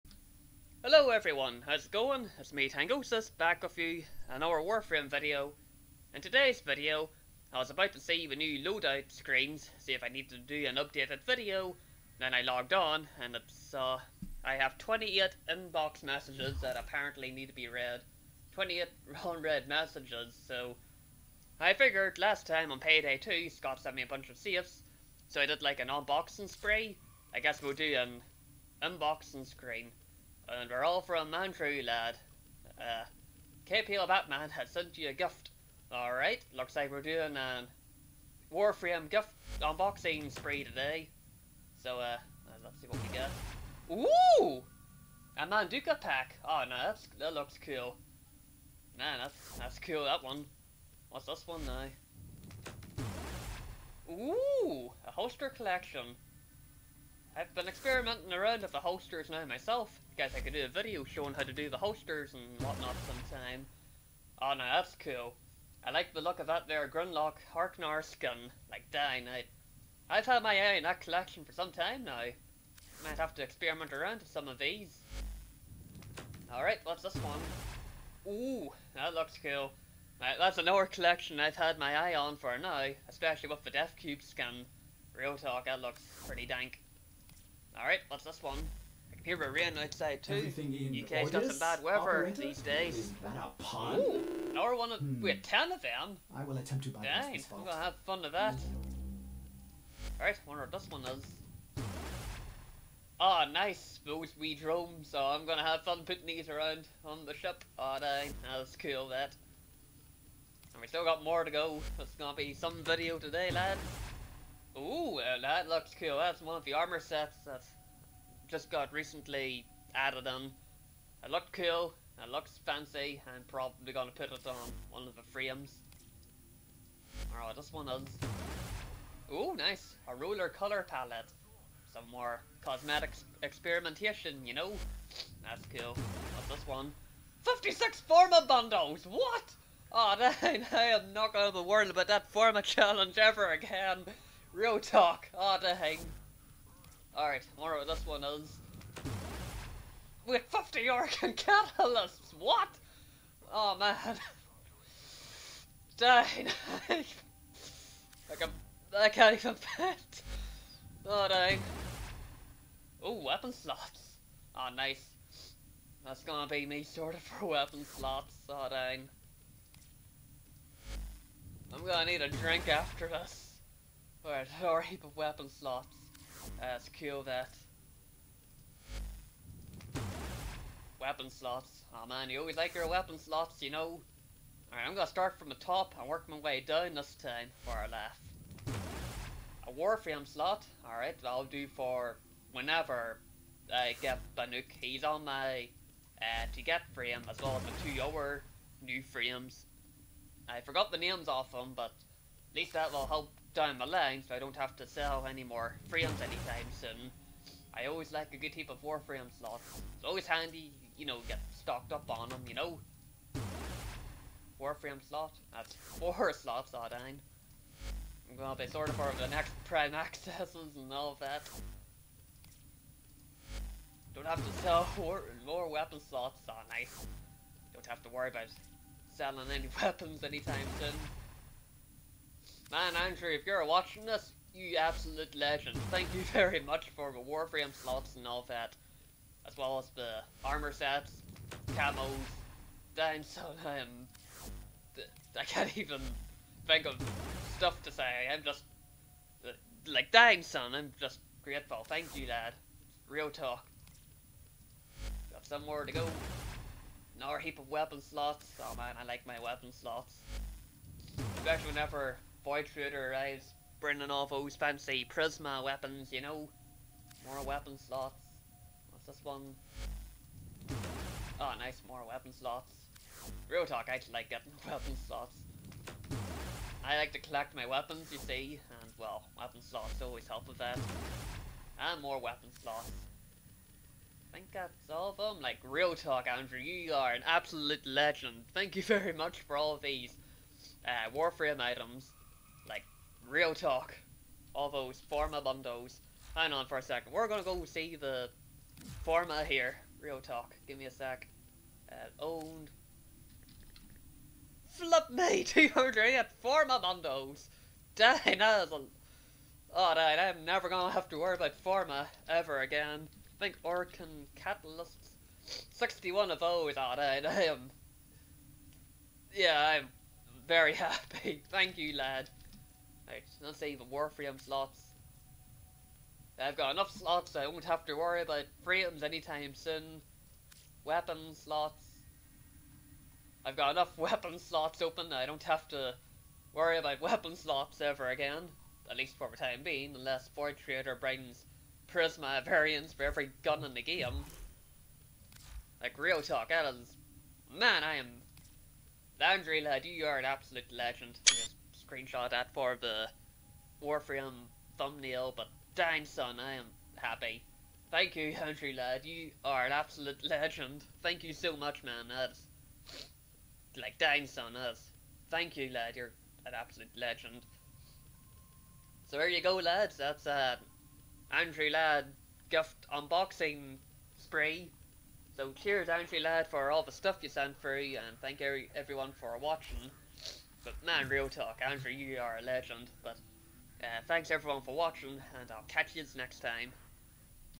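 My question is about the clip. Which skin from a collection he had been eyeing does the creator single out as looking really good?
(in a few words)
Dethcube skin.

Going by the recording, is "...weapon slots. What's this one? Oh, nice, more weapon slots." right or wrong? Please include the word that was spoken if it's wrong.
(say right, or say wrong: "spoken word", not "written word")
right.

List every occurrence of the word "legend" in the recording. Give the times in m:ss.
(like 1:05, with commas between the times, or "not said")
3:55, 4:47, 5:50, 6:00, 6:06, 6:22.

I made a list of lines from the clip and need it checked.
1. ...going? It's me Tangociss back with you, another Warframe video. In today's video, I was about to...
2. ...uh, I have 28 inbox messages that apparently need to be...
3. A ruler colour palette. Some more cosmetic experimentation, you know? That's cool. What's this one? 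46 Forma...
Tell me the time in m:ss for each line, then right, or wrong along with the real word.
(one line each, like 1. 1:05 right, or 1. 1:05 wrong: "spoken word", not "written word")
1. 0:01 right
2. 0:13 right
3. 2:10 wrong: "56", not "46".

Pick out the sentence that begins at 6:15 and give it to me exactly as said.
So cheers, Andrew lad, for all the stuff you sent through, and thank every everyone for watching.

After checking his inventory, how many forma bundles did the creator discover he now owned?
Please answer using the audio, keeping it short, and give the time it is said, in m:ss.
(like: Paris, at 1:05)
208, at 5:05.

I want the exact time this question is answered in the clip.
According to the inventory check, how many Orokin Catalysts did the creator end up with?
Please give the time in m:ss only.
5:15.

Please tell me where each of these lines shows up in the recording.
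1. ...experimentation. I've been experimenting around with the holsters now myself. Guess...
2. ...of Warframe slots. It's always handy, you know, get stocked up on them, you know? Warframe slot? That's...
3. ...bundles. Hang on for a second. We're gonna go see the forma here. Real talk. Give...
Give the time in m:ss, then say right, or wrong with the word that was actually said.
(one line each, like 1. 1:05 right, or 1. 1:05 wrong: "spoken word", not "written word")
1. 0:55 wrong: "collection", not "experimentation"
2. 3:28 right
3. 4:55 right.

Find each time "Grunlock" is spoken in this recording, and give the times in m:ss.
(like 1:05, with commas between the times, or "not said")
1:06.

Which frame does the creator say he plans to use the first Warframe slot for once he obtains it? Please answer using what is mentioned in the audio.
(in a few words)
Baruuk.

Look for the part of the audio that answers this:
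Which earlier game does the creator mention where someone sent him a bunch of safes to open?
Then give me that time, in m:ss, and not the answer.
0:22.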